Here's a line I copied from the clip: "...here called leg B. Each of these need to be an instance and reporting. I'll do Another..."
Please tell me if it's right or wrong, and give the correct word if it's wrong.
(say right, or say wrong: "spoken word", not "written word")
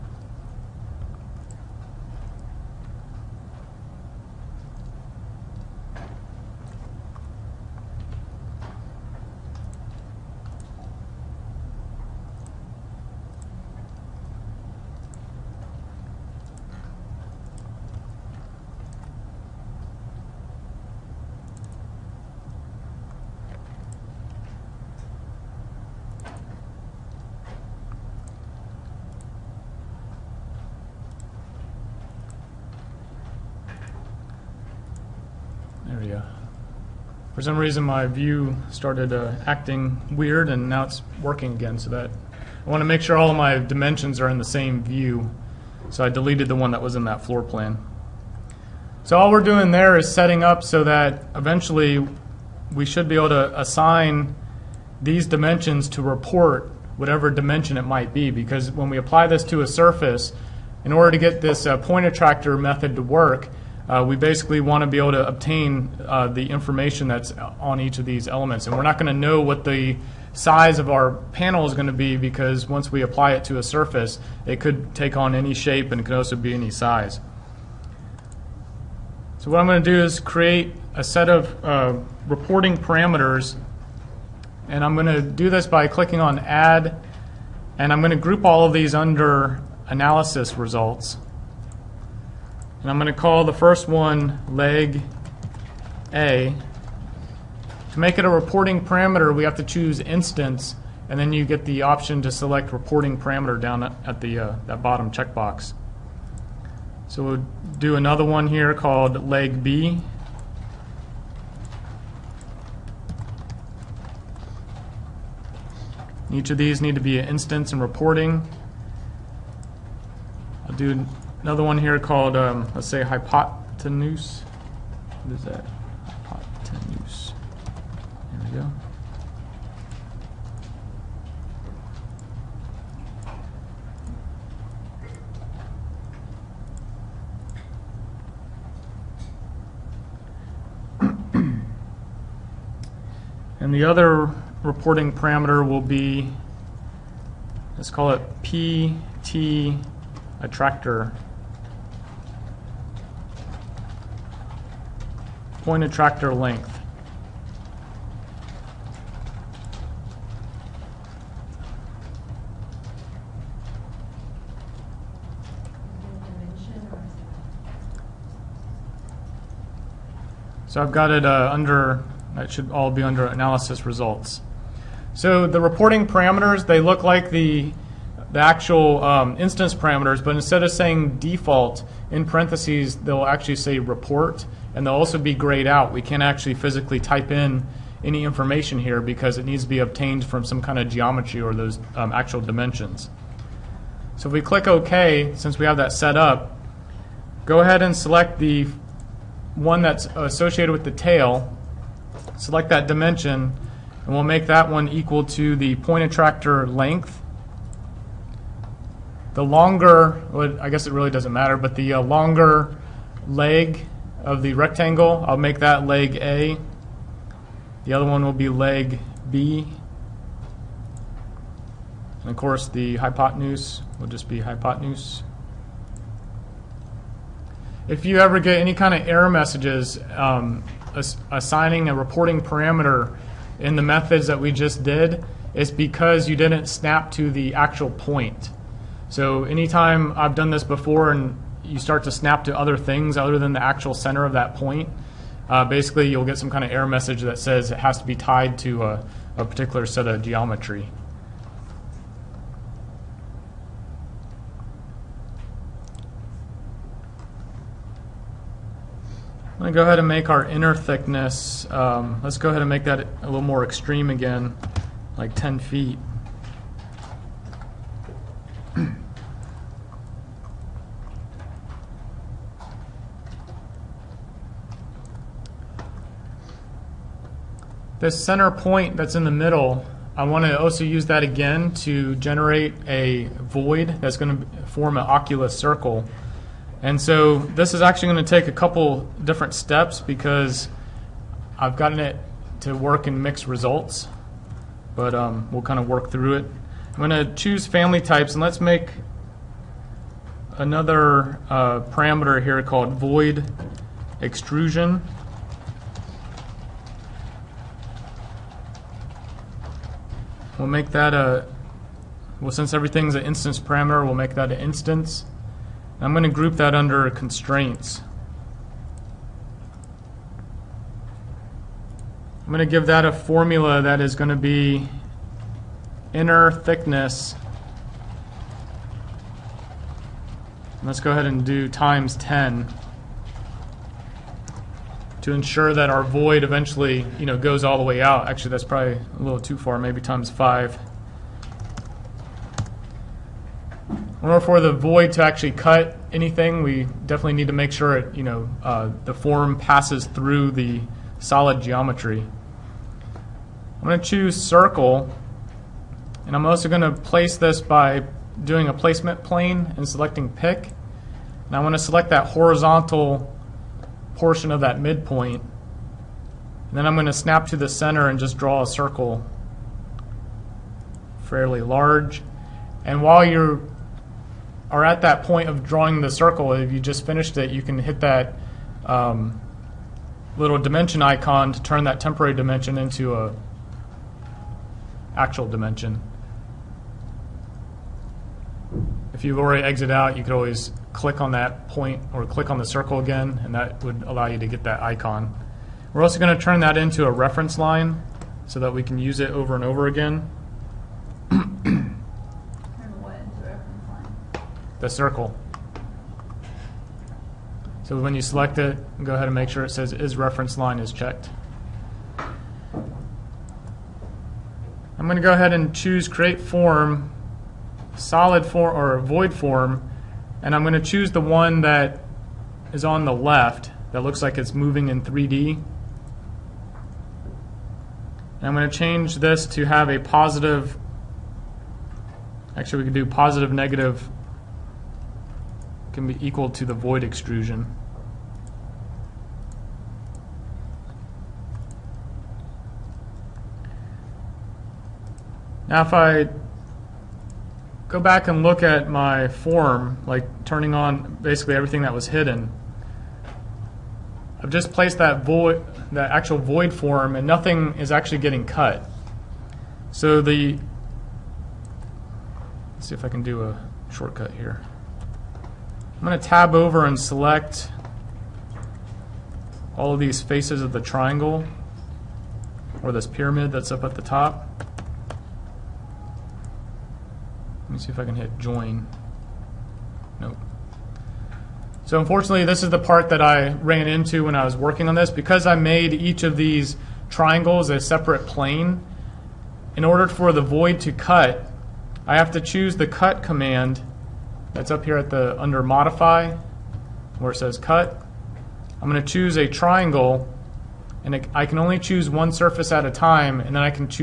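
right.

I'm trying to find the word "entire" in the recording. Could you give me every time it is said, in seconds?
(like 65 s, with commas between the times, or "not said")
not said.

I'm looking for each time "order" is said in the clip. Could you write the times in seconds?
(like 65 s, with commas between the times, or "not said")
60 s, 344 s, 489 s.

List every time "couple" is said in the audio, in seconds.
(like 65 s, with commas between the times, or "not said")
288 s.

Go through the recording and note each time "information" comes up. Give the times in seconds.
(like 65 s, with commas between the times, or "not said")
66 s, 188 s.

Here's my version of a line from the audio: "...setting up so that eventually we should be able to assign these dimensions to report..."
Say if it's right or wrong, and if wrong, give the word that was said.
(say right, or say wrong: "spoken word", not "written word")
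right.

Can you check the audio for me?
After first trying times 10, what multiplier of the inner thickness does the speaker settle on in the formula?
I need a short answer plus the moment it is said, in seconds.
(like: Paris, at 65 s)
5, at 340 s.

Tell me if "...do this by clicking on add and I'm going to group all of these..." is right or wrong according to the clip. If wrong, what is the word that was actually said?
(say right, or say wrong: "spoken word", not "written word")
right.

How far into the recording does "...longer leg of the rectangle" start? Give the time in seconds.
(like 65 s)
212 s.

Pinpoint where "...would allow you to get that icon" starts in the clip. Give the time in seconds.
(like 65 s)
393 s.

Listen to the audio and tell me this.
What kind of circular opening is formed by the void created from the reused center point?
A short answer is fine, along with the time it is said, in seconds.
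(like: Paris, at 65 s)
Oculus, at 285 s.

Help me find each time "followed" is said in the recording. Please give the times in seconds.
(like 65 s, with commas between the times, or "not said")
not said.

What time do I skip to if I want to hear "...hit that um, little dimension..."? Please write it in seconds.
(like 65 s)
377 s.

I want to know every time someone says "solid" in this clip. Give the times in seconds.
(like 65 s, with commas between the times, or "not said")
351 s, 417 s.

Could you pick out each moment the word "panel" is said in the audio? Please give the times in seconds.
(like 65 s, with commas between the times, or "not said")
71 s.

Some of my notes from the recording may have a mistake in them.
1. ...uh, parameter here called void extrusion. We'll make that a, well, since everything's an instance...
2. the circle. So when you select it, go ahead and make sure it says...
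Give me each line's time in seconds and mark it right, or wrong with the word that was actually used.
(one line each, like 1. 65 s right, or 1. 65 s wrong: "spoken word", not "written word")
1. 301 s right
2. 404 s right.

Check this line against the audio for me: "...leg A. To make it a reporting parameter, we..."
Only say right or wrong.
right.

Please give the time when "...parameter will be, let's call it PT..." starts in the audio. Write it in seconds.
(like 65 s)
145 s.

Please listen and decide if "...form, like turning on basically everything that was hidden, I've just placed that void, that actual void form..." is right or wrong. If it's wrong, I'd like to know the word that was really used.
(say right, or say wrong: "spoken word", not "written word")
right.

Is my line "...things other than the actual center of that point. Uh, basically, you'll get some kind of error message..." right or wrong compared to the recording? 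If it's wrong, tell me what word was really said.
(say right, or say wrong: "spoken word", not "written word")
right.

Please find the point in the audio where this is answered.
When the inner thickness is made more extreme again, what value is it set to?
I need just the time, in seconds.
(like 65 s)
265 s.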